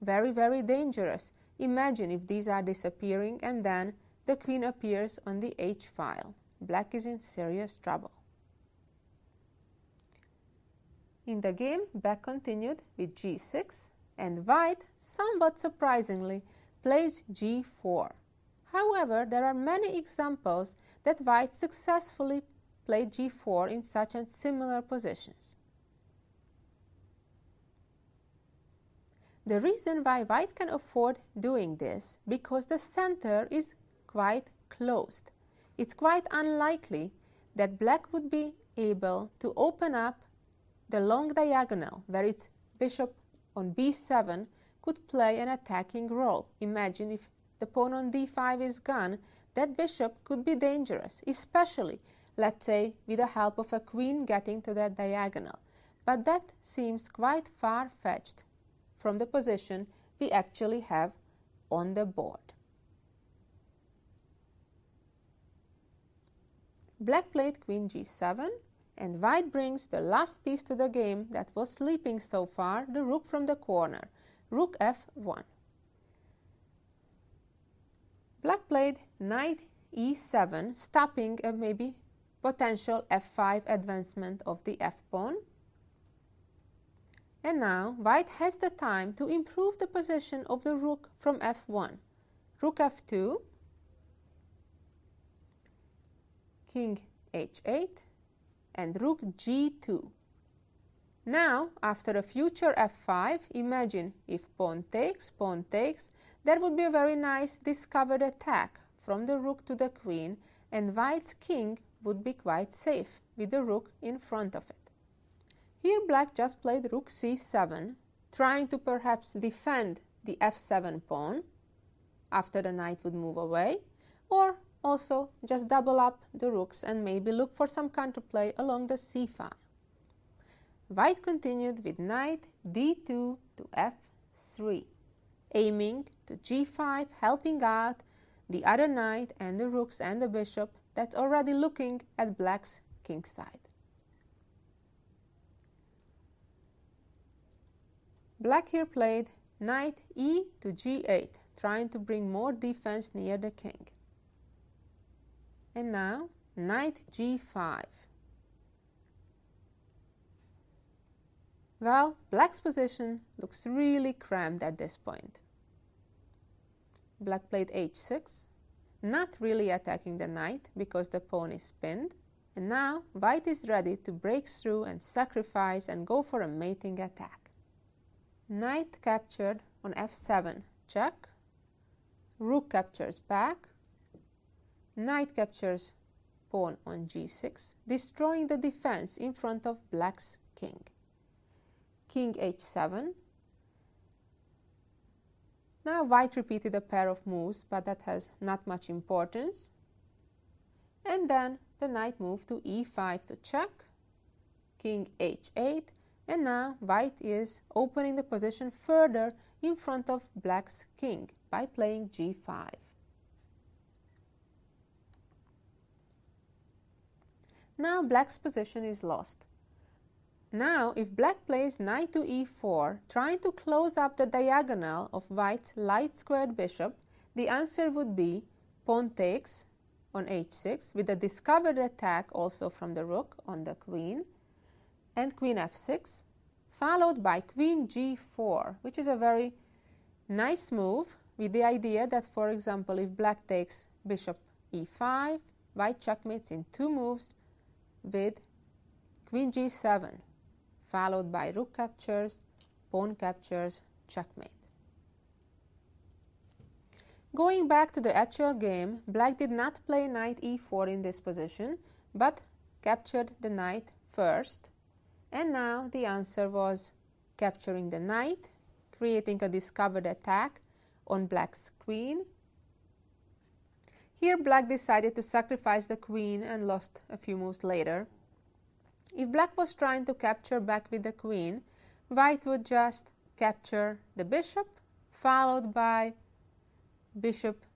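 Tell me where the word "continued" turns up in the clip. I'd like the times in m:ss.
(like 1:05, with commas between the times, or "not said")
0:12, 2:11.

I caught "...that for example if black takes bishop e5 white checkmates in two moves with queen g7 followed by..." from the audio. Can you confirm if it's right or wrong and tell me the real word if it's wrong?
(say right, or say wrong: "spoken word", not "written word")
right.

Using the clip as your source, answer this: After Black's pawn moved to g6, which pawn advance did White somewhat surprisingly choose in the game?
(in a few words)
g4.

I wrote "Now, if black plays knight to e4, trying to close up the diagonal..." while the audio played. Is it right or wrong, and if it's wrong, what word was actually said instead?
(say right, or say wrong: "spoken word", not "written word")
right.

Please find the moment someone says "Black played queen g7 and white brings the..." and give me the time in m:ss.
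1:06.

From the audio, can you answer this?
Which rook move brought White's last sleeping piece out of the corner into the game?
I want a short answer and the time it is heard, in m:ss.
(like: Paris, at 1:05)
Rook f1, at 1:14.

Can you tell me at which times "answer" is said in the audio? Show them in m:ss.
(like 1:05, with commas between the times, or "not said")
3:47, 4:26.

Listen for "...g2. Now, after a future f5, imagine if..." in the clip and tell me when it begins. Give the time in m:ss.
1:39.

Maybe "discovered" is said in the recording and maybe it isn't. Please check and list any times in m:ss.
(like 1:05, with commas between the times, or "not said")
1:47, 3:51, 4:29.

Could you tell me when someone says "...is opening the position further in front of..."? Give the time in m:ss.
3:27.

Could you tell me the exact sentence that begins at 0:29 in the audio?
The reason why white can afford doing this because the center is quite closed.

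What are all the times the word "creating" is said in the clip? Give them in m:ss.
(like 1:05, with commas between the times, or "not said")
4:28.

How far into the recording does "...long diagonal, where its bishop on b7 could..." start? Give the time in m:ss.
0:40.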